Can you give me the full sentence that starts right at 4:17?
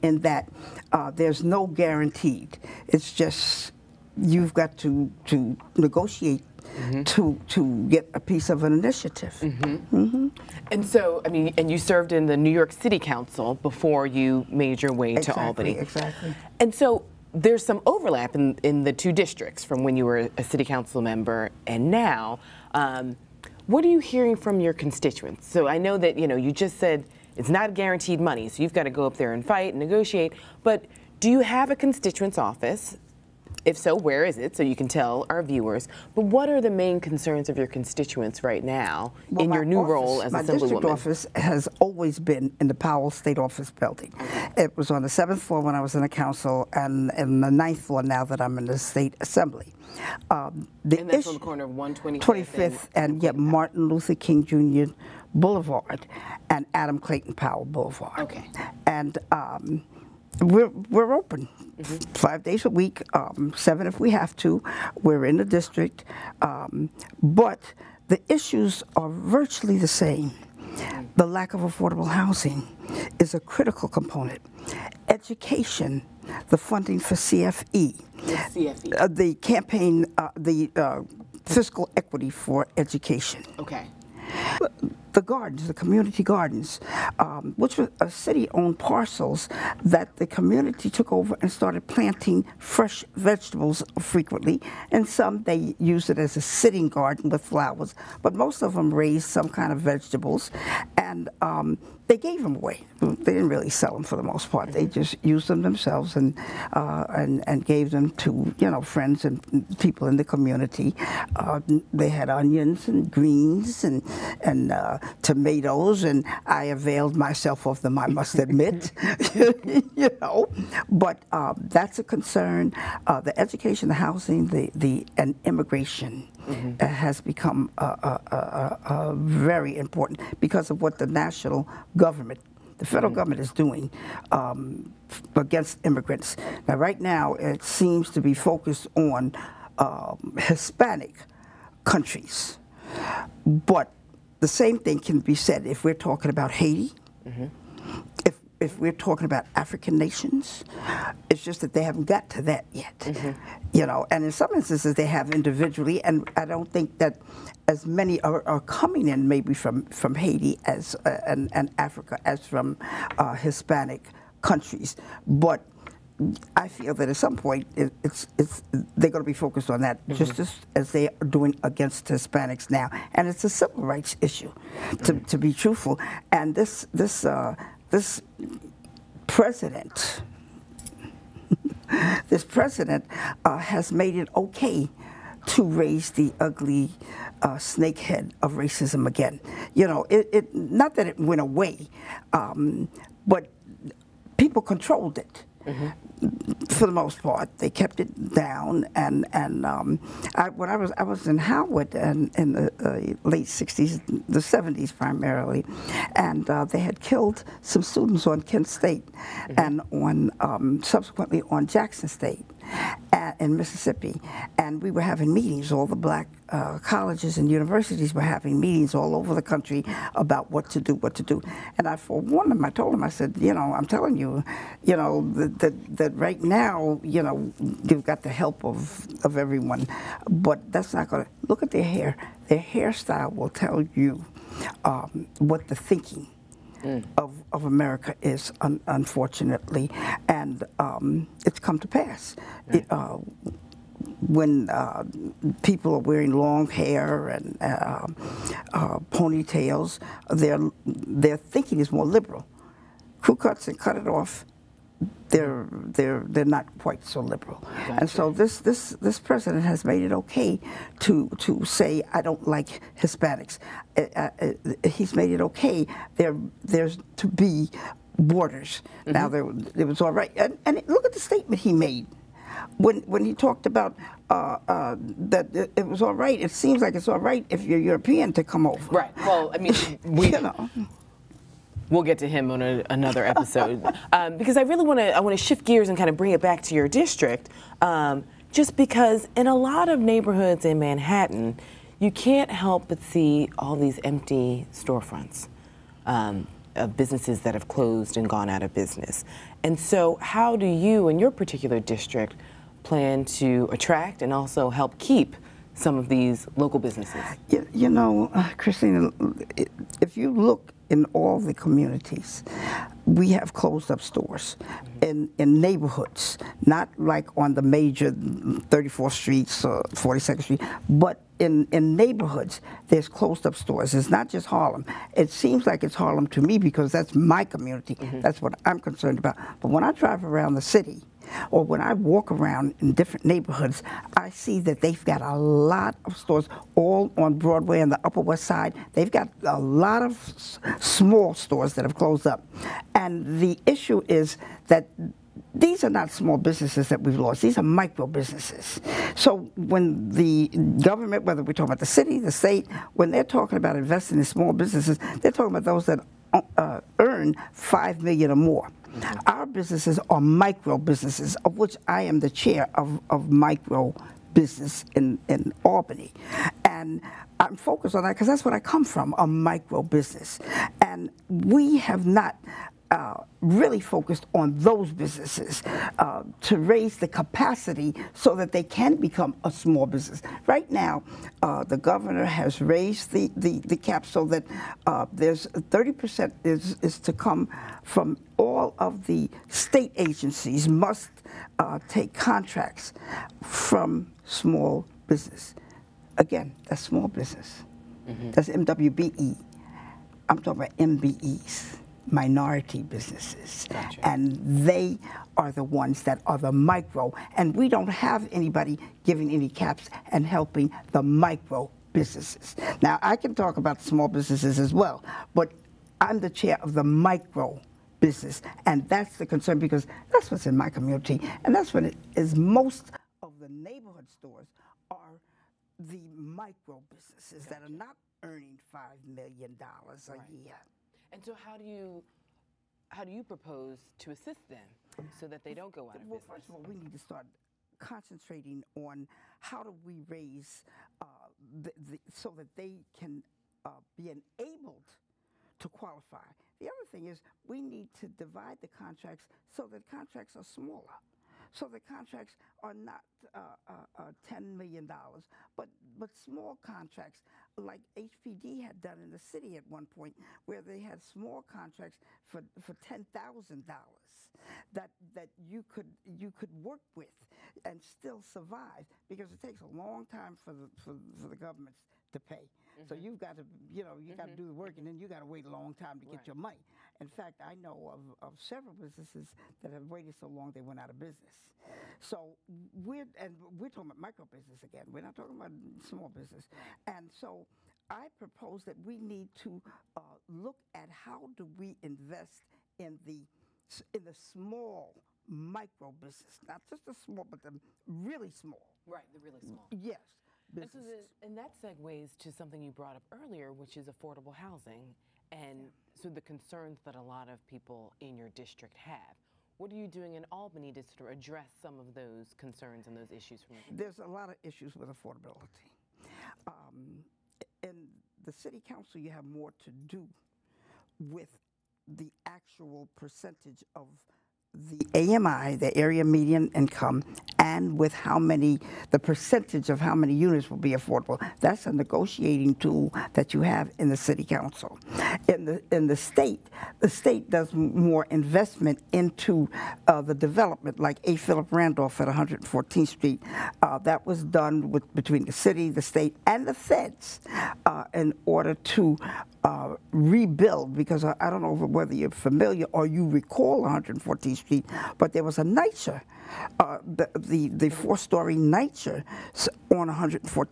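and so this this this president has made it okay to to say I don't like Hispanics.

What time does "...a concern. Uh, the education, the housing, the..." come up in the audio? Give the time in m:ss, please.
2:01.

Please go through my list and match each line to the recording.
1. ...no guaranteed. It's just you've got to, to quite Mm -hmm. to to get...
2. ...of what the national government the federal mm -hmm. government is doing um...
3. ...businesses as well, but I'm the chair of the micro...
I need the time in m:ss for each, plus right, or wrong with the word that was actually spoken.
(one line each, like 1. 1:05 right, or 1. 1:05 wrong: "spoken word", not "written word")
1. 0:01 wrong: "negotiate", not "quite"
2. 2:10 right
3. 6:54 right.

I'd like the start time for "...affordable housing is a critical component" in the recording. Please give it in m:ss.
1:11.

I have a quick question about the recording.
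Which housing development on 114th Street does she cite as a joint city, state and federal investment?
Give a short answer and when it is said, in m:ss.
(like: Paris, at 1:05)
A. Philip Randolph, at 9:01.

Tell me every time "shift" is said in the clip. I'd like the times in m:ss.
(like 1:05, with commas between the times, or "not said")
4:45.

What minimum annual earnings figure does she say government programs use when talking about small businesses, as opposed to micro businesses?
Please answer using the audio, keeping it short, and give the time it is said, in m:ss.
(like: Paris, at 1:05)
5 million, at 5:57.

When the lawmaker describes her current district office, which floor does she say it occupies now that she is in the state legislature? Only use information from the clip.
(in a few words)
ninth floor.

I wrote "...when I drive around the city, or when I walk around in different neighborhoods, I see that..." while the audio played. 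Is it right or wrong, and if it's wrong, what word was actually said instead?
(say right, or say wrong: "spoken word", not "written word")
right.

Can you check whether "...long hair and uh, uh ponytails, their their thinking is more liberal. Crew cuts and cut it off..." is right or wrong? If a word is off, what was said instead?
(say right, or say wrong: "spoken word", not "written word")
right.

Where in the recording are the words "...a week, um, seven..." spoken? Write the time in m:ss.
1:02.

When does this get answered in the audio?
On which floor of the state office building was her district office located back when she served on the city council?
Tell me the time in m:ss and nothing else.
0:45.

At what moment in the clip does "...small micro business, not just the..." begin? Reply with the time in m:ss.
8:14.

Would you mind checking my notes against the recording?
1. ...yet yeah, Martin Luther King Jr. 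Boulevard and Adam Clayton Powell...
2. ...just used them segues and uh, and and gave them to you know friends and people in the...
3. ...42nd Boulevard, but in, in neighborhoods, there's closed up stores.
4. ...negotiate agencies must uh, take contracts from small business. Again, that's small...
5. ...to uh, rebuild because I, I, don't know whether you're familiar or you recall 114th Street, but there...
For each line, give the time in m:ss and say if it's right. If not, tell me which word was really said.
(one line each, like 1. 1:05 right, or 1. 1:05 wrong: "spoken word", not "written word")
1. 0:53 right
2. 1:44 wrong: "themselves", not "segues"
3. 5:19 wrong: "Street", not "Boulevard"
4. 6:29 wrong: "state", not "negotiate"
5. 9:08 right.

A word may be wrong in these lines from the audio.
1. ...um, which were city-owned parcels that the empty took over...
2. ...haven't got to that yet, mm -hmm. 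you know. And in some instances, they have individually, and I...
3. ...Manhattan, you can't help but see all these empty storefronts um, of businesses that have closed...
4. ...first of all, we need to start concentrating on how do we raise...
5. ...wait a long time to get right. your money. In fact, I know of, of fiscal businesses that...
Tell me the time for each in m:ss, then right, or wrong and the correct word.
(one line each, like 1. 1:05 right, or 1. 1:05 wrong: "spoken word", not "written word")
1. 1:27 wrong: "community", not "empty"
2. 2:31 right
3. 4:50 right
4. 7:16 right
5. 7:55 wrong: "several", not "fiscal".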